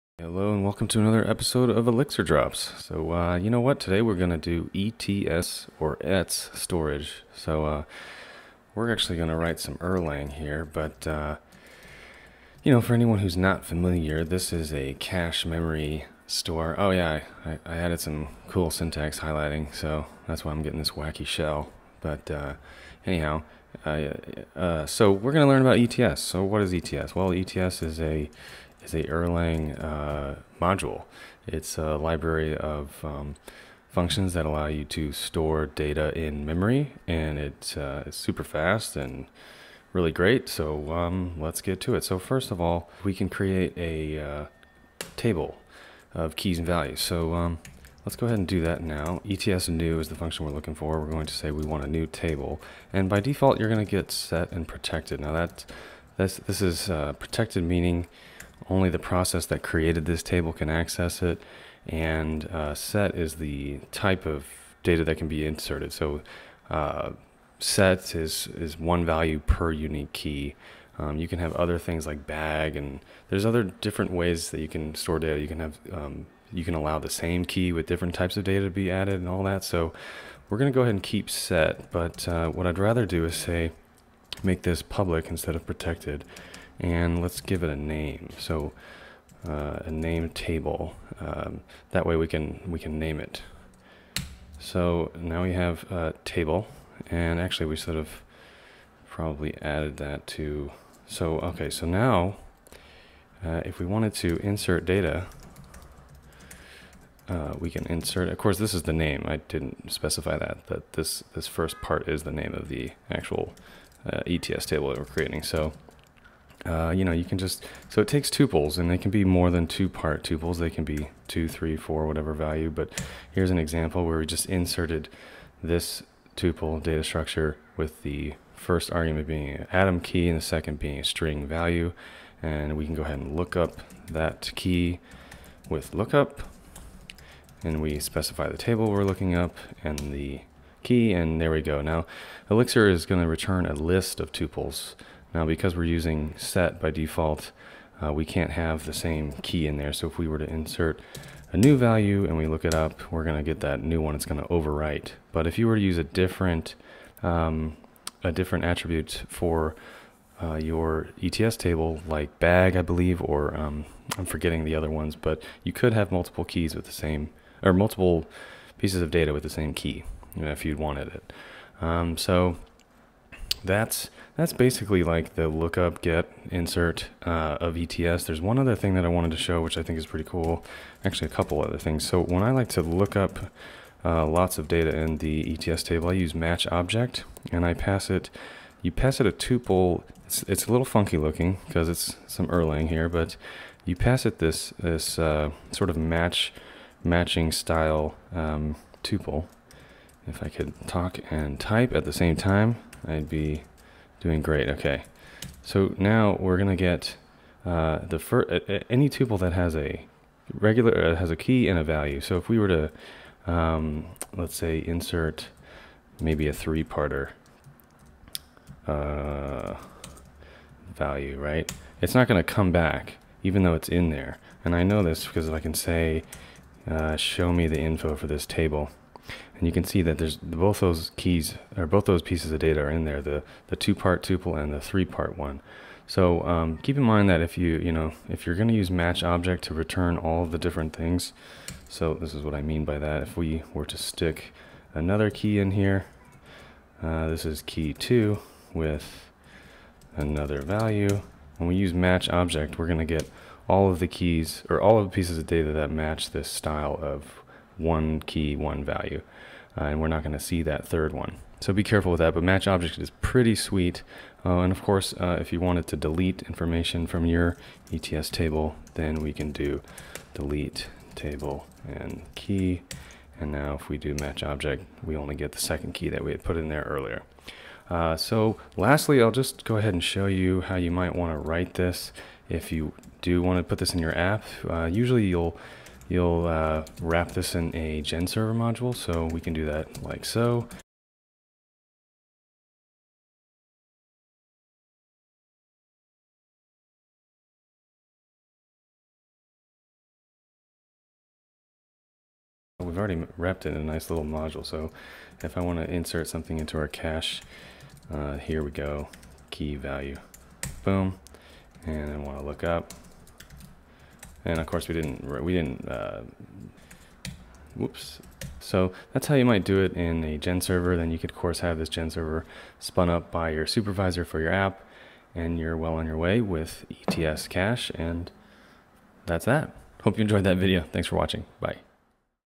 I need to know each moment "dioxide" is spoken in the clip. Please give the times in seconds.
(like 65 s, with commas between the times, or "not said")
not said.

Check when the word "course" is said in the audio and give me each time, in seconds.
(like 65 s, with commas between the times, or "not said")
108 s, 264 s, 314 s, 321 s.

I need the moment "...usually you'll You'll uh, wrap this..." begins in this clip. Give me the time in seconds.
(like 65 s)
284 s.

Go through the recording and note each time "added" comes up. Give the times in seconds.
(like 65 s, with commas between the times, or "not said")
17 s, 78 s, 99 s.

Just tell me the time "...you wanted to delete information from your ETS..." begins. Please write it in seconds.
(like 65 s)
265 s.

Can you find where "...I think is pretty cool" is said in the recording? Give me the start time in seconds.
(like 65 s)
179 s.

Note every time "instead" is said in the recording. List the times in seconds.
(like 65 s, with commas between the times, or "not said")
85 s.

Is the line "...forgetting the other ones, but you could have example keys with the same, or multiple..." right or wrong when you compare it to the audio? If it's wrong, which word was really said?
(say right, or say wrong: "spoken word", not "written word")
wrong: "multiple", not "example".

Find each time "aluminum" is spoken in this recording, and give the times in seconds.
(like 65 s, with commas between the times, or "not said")
not said.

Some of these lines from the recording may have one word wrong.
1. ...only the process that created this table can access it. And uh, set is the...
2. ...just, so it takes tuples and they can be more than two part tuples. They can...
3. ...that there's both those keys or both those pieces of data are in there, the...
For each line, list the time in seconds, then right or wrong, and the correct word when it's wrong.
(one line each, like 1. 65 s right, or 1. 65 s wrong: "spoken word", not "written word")
1. 58 s right
2. 117 s right
3. 230 s right.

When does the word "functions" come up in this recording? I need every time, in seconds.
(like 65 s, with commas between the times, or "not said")
33 s, 50 s.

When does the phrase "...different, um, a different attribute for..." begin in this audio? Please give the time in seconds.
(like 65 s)
156 s.